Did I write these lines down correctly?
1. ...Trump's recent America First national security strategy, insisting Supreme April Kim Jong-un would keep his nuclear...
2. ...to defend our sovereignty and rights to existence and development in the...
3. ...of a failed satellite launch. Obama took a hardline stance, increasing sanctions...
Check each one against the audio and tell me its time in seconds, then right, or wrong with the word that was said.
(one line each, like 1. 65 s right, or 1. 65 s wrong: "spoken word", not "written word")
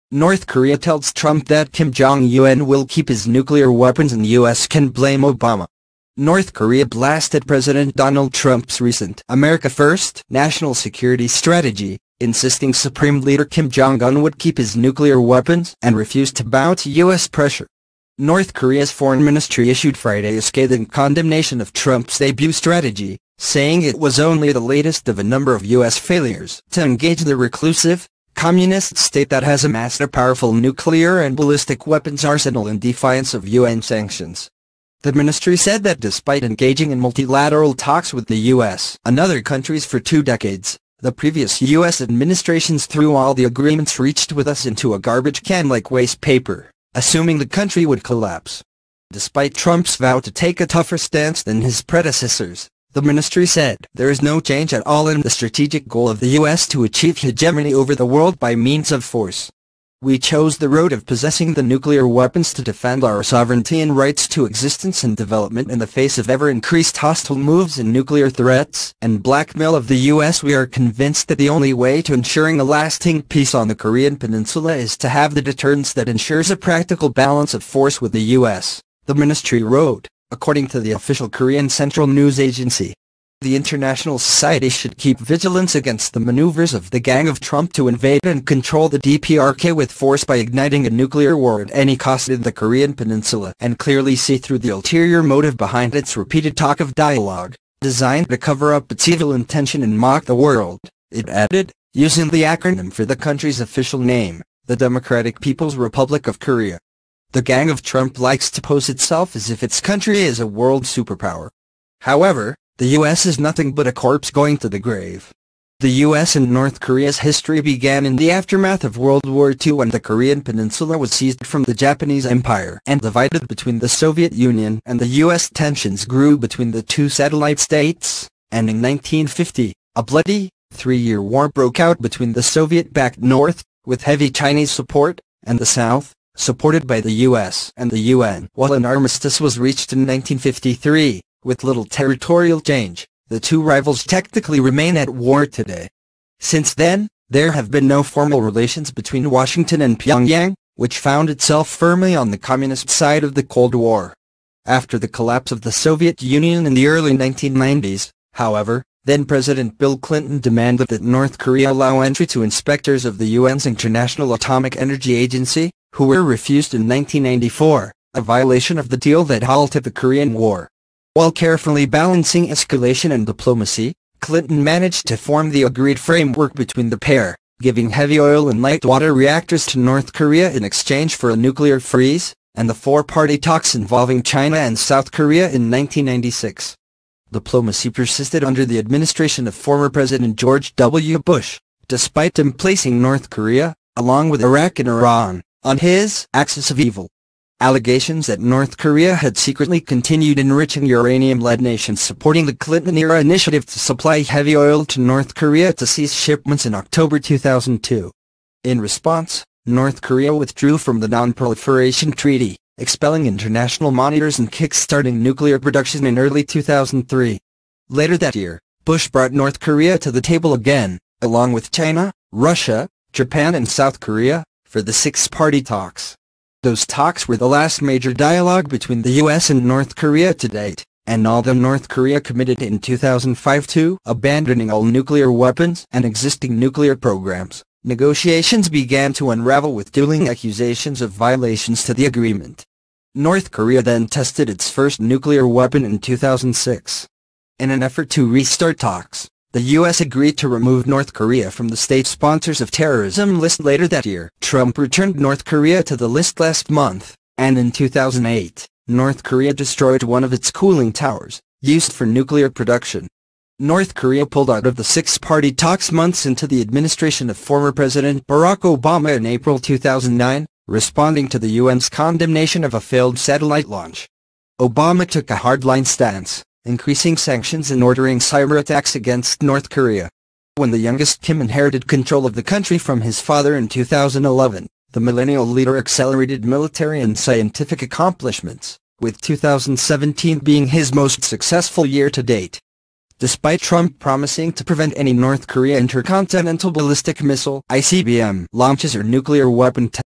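1. 8 s wrong: "Leader", not "April"
2. 62 s right
3. 272 s right.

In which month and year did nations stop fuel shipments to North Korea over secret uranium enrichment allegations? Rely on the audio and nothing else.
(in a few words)
October 2002.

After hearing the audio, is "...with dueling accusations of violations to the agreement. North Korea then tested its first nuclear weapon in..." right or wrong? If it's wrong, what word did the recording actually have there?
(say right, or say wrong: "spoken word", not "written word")
right.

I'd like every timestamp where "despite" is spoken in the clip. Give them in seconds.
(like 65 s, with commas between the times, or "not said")
35 s, 49 s, 191 s, 293 s.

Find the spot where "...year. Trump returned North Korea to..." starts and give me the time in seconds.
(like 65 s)
254 s.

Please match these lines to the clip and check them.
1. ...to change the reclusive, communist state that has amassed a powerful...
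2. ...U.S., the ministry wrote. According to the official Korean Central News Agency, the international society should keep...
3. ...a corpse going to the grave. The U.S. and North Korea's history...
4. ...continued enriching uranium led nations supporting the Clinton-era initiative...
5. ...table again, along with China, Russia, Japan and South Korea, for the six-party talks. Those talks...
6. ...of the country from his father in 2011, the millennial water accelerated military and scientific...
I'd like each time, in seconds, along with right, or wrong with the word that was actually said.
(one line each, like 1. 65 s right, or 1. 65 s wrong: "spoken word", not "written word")
1. 26 s wrong: "engage", not "change"
2. 78 s right
3. 113 s right
4. 199 s right
5. 220 s right
6. 282 s wrong: "leader", not "water".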